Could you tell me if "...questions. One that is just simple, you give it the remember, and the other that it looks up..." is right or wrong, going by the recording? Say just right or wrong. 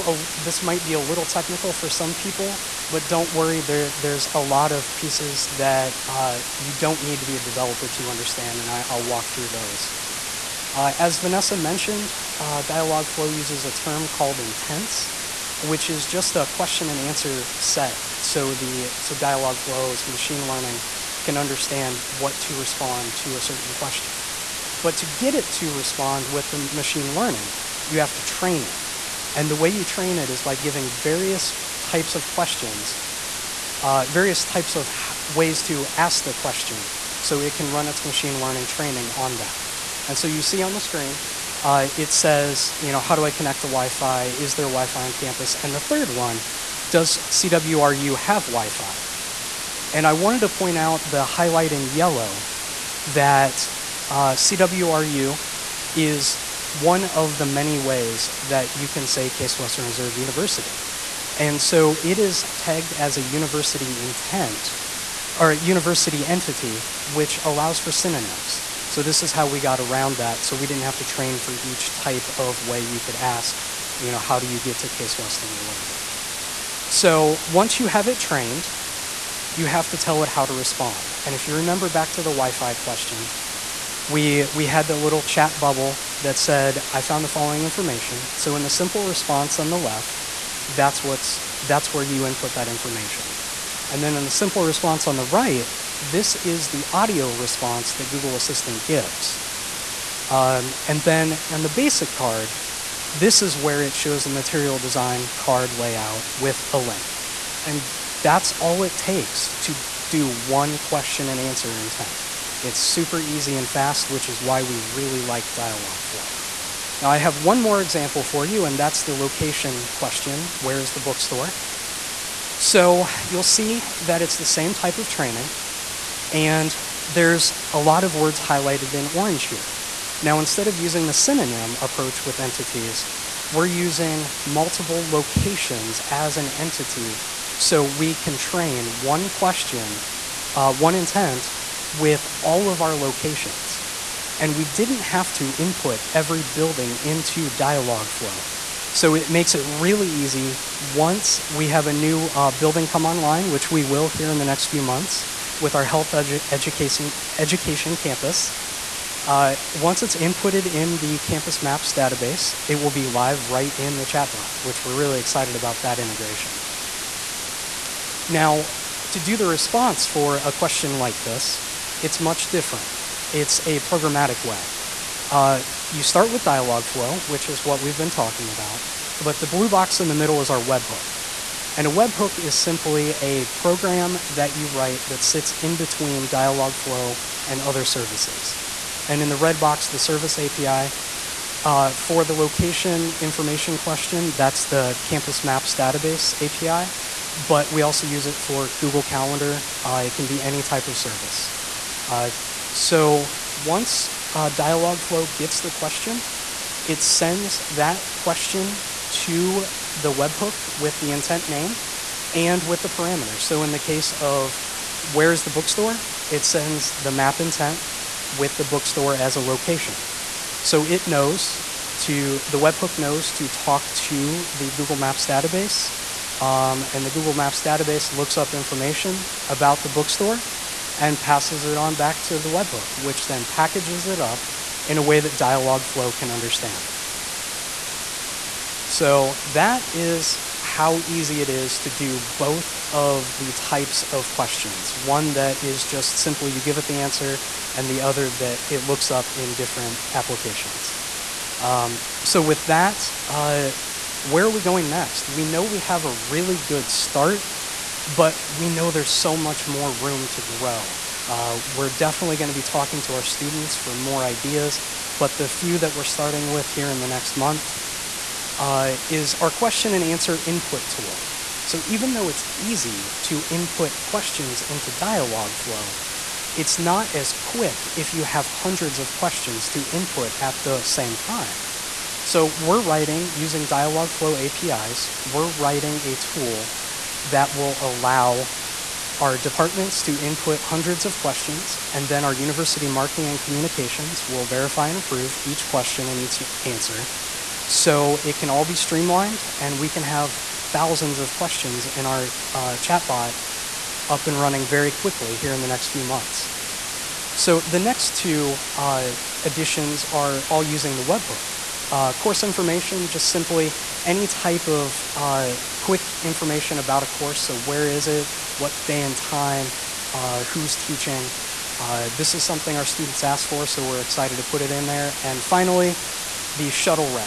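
wrong.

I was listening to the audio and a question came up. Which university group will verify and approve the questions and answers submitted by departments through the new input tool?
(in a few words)
University marketing and communications.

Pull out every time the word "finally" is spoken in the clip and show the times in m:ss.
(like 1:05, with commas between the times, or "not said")
5:25.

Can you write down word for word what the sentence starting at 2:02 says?
So you'll see that it's the same type of training, and there's a lot of words highlighted in orange here.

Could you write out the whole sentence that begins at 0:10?
Uh, as Vanessa mentioned, uh, Dialogflow uses a term called intents, which is just a question and answer set.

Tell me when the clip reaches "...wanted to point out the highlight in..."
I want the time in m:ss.
0:50.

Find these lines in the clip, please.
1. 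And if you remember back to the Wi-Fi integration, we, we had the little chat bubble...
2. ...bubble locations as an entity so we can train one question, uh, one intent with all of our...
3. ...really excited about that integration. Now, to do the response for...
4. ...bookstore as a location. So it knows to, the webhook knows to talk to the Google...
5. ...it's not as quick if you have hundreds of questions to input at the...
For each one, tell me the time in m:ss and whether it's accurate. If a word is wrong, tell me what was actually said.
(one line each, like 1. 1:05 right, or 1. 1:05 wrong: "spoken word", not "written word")
1. 1:21 wrong: "question", not "integration"
2. 2:14 wrong: "multiple", not "bubble"
3. 2:44 right
4. 3:38 right
5. 4:36 right.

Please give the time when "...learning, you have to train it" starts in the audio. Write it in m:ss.
0:27.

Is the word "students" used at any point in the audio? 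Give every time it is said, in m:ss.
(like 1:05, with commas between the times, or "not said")
4:23, 5:22.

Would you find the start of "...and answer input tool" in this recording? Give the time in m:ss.
4:29.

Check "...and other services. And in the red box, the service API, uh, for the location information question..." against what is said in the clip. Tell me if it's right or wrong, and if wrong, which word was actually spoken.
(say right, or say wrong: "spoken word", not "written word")
right.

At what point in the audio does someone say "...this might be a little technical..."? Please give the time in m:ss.
0:00.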